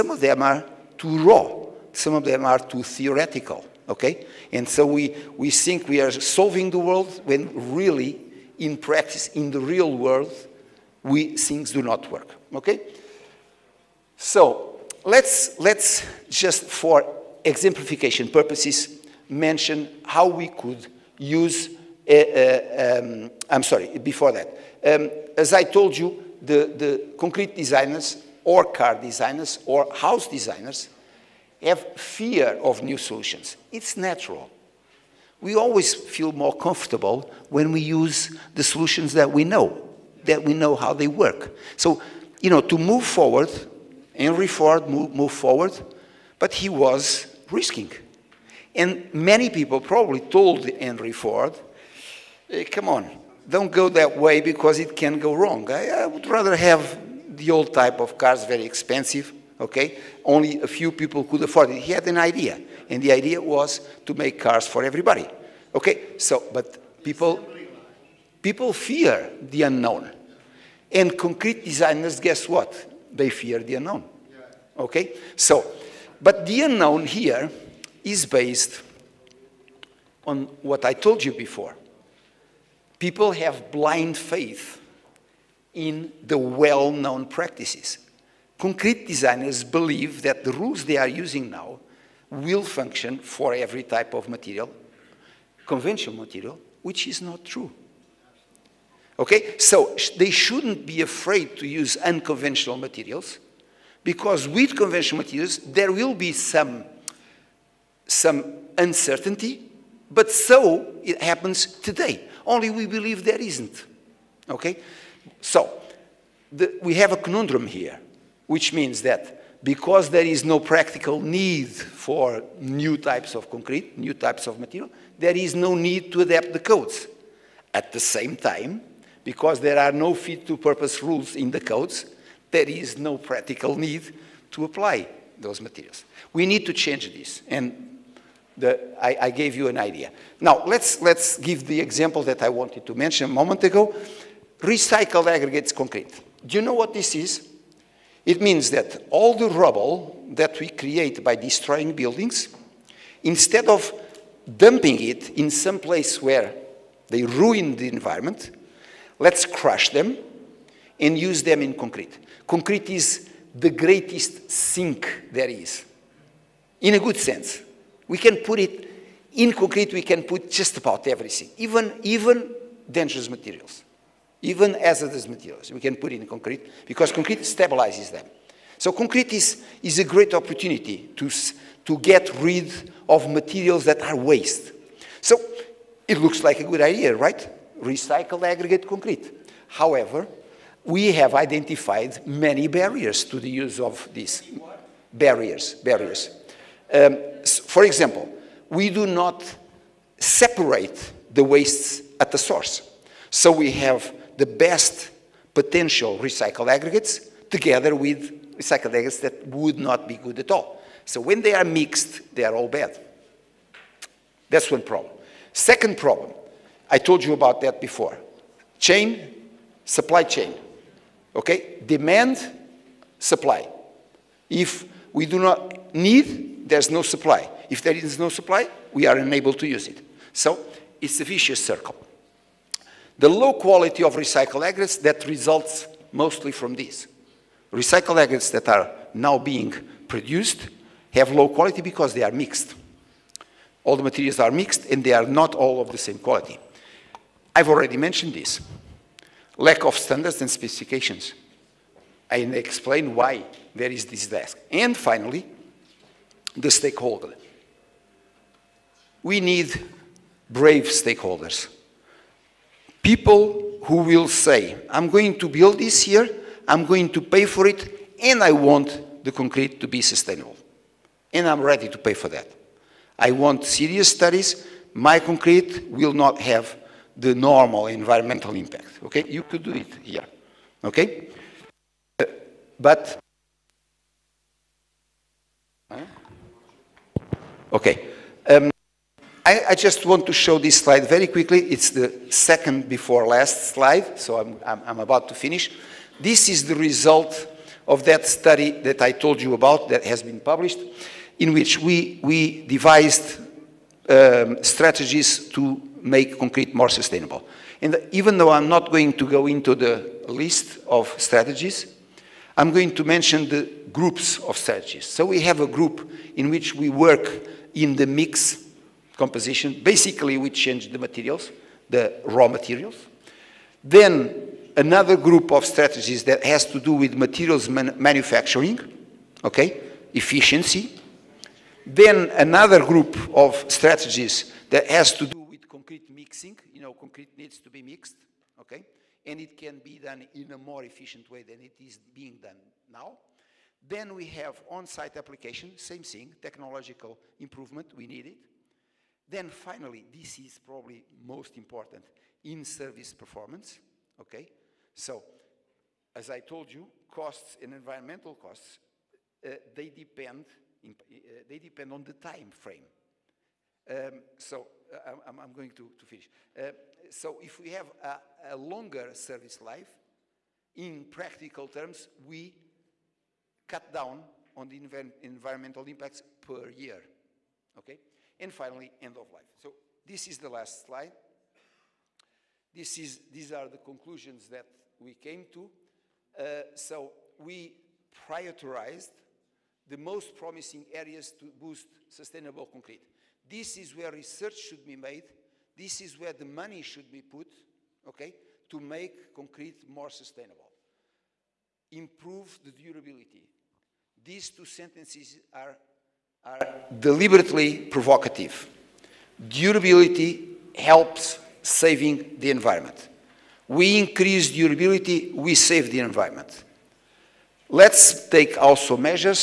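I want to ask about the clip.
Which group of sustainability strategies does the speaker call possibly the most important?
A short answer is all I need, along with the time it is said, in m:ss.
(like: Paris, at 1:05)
in-service performance, at 5:52.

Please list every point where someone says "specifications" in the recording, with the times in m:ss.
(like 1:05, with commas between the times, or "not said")
4:10.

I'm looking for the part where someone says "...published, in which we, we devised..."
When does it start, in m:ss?
5:00.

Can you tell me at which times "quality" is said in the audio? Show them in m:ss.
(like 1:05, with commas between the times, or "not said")
3:53, 4:01, 4:06.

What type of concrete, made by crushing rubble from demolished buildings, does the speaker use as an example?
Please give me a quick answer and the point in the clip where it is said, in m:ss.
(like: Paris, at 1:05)
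Recycled aggregates concrete, at 2:24.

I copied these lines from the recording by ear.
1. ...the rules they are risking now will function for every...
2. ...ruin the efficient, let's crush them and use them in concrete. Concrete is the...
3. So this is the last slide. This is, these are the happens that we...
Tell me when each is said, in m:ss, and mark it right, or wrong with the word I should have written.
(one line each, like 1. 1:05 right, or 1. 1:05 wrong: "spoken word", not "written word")
1. 1:30 wrong: "using", not "risking"
2. 2:37 wrong: "environment", not "efficient"
3. 6:19 wrong: "conclusions", not "happens".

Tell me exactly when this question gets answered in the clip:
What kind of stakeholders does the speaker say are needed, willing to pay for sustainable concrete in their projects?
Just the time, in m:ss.
4:20.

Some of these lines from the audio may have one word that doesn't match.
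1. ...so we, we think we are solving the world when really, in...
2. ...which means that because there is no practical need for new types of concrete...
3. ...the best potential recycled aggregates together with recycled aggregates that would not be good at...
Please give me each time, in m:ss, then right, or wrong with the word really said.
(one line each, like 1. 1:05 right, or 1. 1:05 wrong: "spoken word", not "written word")
1. 0:04 right
2. 1:58 right
3. 3:24 right.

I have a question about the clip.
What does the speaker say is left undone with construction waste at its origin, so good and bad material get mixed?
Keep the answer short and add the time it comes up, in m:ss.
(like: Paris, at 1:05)
separate the wastes, at 3:20.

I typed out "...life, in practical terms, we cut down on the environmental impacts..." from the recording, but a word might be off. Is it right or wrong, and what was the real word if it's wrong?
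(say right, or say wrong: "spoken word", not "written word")
right.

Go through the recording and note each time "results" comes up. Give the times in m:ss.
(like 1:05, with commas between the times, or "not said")
3:55, 4:56.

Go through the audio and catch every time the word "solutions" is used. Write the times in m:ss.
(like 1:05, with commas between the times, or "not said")
0:32, 0:38.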